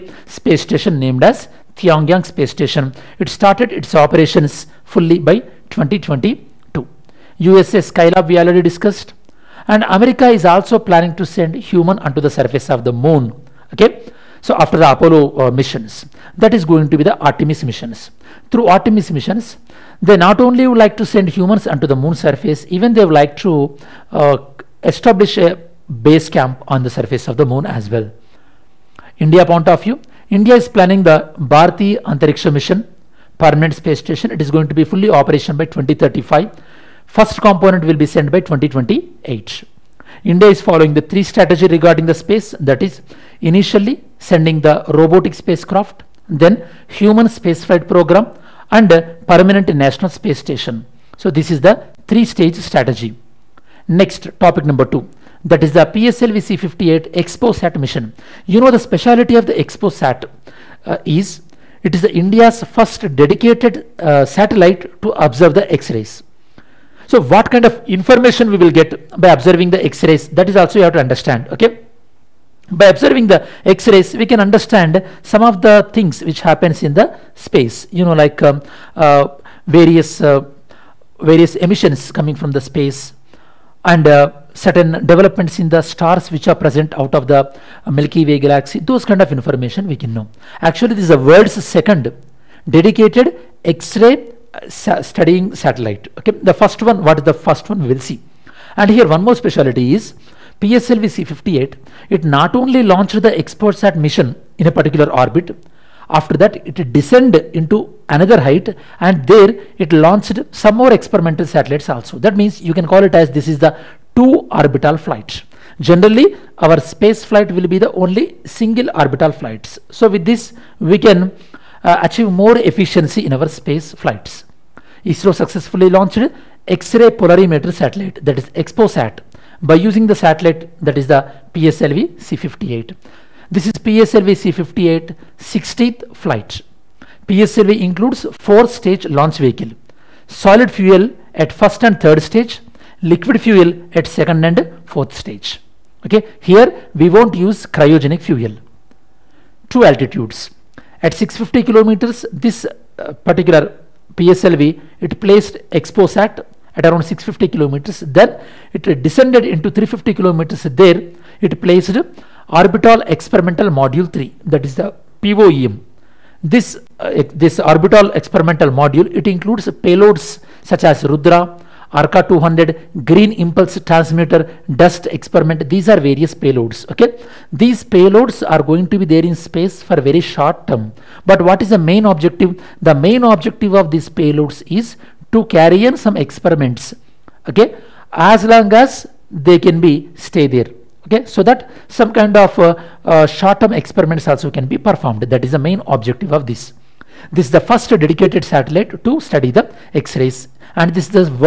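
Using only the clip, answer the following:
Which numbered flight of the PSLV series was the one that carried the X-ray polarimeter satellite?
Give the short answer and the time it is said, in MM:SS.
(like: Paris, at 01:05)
60th, at 02:15.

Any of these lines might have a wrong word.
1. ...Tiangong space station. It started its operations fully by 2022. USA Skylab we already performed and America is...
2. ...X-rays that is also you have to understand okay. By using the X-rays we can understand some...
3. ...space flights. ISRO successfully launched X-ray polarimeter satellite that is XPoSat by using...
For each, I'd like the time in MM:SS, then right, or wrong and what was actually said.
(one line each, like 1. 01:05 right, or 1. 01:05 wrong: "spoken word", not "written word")
1. 00:01 wrong: "discussed", not "performed"
2. 01:09 wrong: "observing", not "using"
3. 02:03 right.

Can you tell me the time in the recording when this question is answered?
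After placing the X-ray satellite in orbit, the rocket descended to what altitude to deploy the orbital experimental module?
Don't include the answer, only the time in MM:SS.
02:39.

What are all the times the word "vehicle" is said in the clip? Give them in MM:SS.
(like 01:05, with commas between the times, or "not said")
02:19.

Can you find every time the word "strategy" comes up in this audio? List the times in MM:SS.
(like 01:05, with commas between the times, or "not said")
00:41, 00:52.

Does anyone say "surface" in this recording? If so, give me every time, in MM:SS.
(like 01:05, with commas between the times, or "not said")
00:12, 00:22, 00:26.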